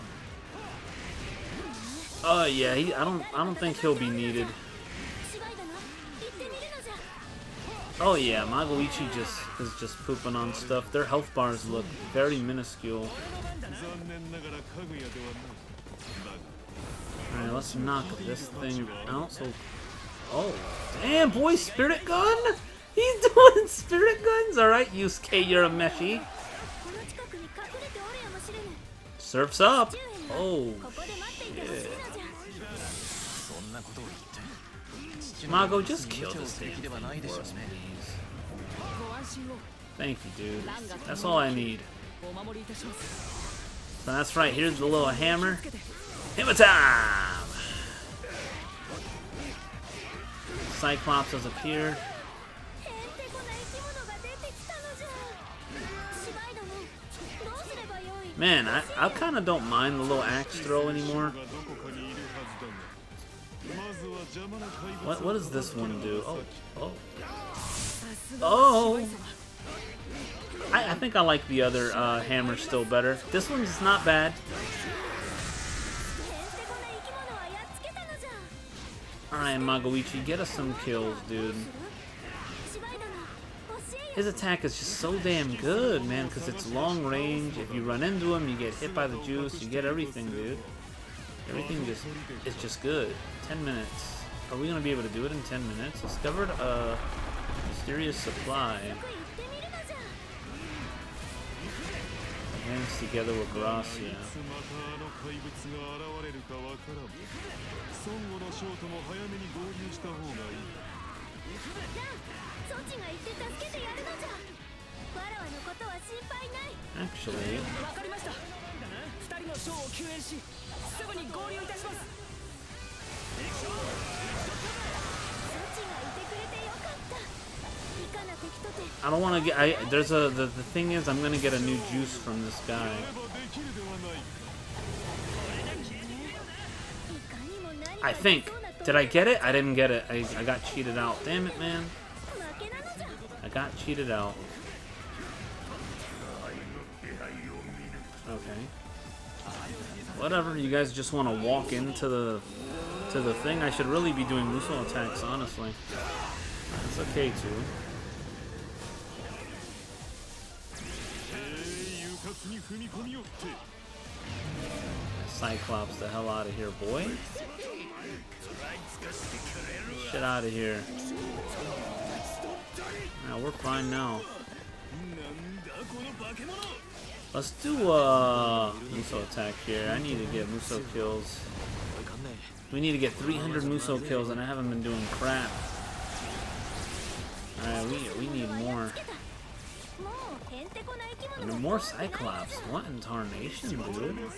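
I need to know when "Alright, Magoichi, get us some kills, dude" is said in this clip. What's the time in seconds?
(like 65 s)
79 s.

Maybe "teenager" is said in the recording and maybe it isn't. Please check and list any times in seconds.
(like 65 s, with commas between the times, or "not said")
not said.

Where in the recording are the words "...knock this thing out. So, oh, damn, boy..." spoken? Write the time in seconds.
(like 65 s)
17 s.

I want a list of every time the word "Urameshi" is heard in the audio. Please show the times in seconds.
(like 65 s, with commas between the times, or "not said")
25 s.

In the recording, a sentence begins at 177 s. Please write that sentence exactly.
Let's do a uh, Muso attack here.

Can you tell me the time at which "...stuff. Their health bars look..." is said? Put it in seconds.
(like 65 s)
10 s.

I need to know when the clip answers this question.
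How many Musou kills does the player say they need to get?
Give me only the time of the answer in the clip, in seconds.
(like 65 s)
183 s.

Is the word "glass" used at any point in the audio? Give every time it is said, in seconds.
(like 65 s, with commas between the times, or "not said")
103 s.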